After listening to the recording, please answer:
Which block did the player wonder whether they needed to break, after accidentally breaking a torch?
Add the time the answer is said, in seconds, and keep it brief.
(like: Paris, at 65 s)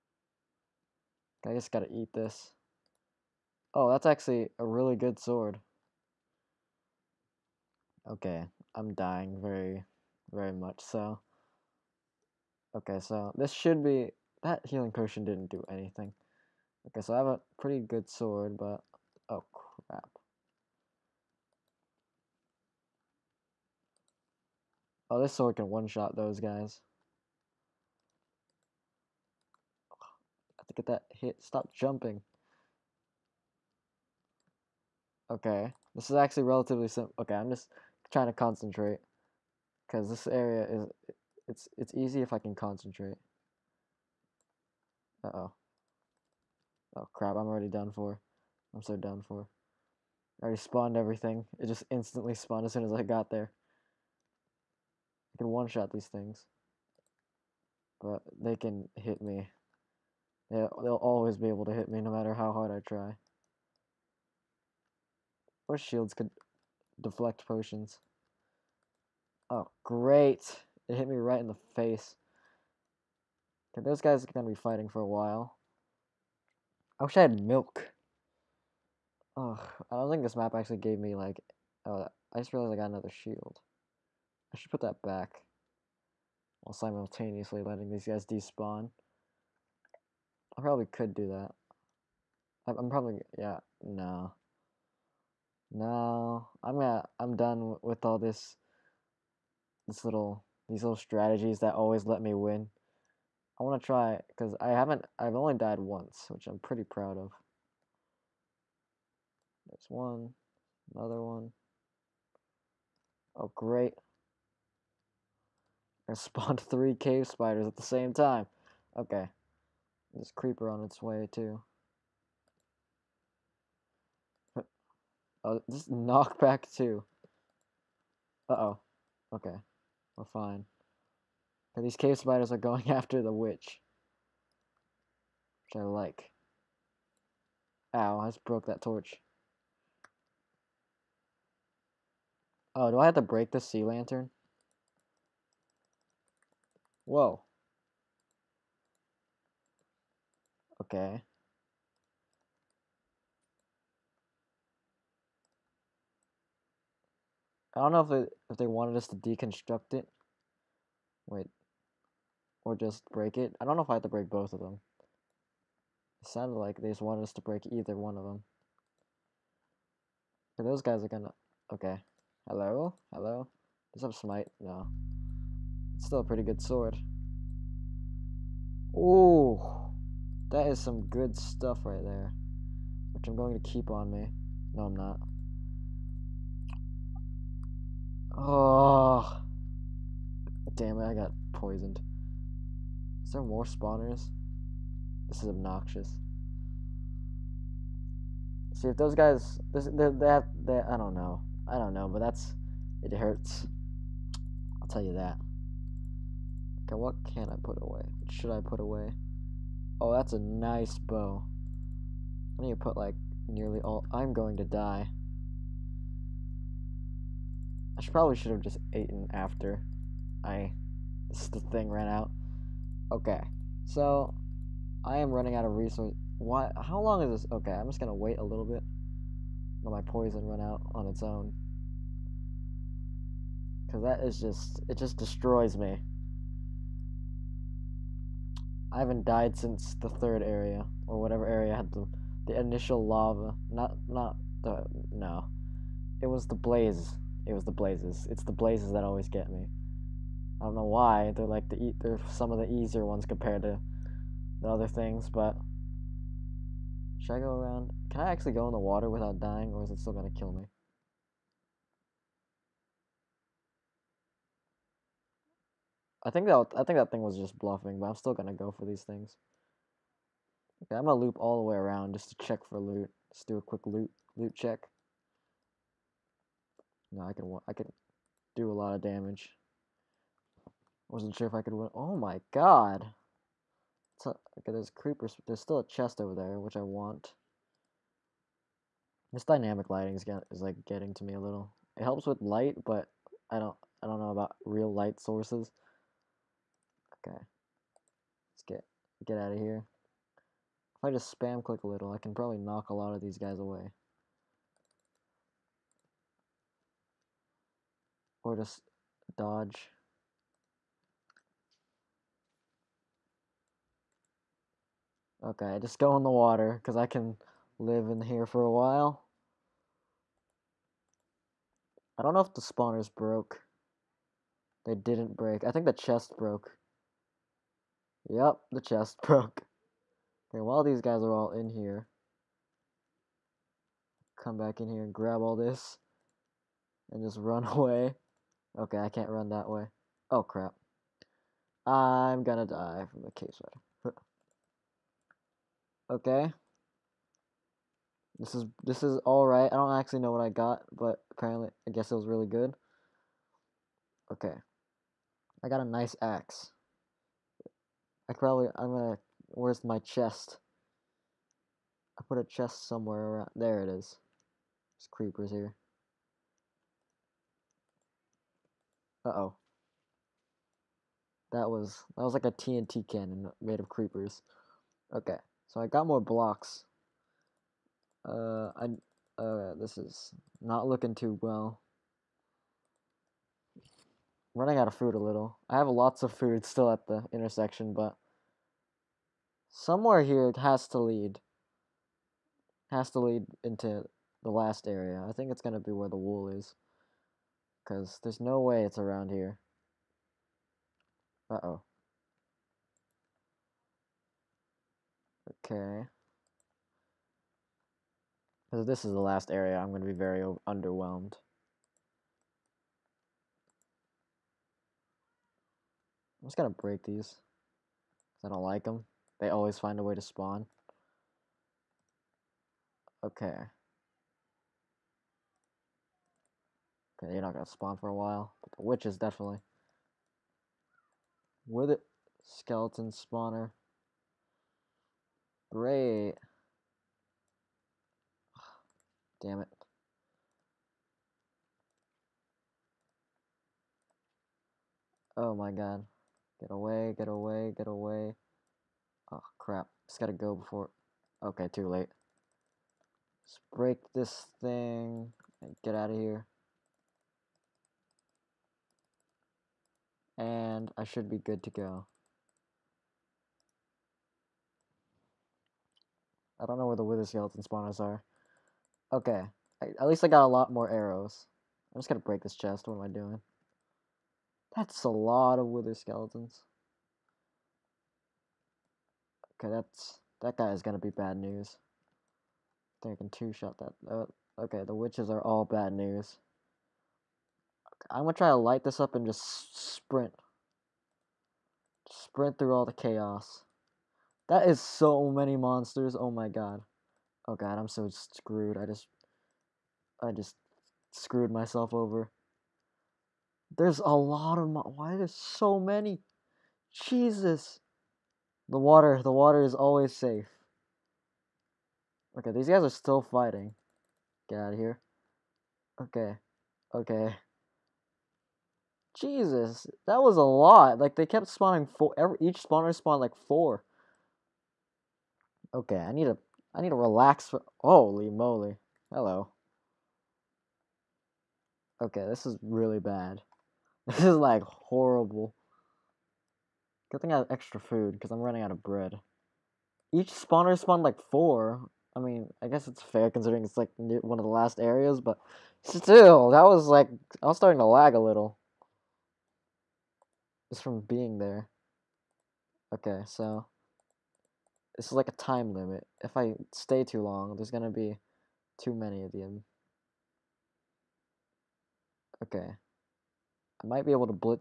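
Sea lantern, at 143 s.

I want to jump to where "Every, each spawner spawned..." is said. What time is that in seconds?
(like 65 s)
522 s.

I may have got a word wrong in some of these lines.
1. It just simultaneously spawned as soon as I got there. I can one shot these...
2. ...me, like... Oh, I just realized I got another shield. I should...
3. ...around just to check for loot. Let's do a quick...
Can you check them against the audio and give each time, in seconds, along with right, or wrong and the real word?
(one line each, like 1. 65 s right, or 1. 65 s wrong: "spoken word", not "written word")
1. 51 s wrong: "instantly", not "simultaneously"
2. 80 s right
3. 271 s right.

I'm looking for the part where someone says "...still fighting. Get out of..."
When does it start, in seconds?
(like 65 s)
512 s.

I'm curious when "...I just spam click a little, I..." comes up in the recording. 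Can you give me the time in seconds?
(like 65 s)
301 s.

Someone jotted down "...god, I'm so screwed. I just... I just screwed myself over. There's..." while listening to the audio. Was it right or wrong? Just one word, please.
right.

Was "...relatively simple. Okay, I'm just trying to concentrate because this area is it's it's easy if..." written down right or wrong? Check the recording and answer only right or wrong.
right.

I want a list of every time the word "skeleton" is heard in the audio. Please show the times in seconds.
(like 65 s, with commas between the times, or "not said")
432 s, 467 s, 475 s.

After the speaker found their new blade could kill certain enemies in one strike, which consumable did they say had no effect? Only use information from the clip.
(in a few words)
Healing potion.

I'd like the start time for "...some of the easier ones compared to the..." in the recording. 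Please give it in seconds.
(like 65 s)
252 s.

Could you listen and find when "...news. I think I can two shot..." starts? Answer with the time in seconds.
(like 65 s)
481 s.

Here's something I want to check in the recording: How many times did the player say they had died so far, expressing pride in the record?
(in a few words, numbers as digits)
Once.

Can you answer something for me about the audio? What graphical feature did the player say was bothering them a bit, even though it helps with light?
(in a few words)
Dynamic lighting.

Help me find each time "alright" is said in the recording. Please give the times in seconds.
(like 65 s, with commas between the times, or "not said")
349 s.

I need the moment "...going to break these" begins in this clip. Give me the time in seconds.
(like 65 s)
416 s.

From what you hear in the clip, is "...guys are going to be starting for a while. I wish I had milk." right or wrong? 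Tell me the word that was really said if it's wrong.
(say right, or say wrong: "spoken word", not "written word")
wrong: "fighting", not "starting".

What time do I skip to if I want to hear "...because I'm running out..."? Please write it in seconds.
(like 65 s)
538 s.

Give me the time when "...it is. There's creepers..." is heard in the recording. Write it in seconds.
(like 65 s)
363 s.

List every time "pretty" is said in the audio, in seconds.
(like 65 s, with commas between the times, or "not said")
17 s, 106 s, 176 s.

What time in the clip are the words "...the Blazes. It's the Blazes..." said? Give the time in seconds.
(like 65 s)
247 s.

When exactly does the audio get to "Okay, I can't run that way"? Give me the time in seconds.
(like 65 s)
338 s.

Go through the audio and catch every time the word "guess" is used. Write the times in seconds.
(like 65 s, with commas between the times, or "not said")
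351 s, 542 s.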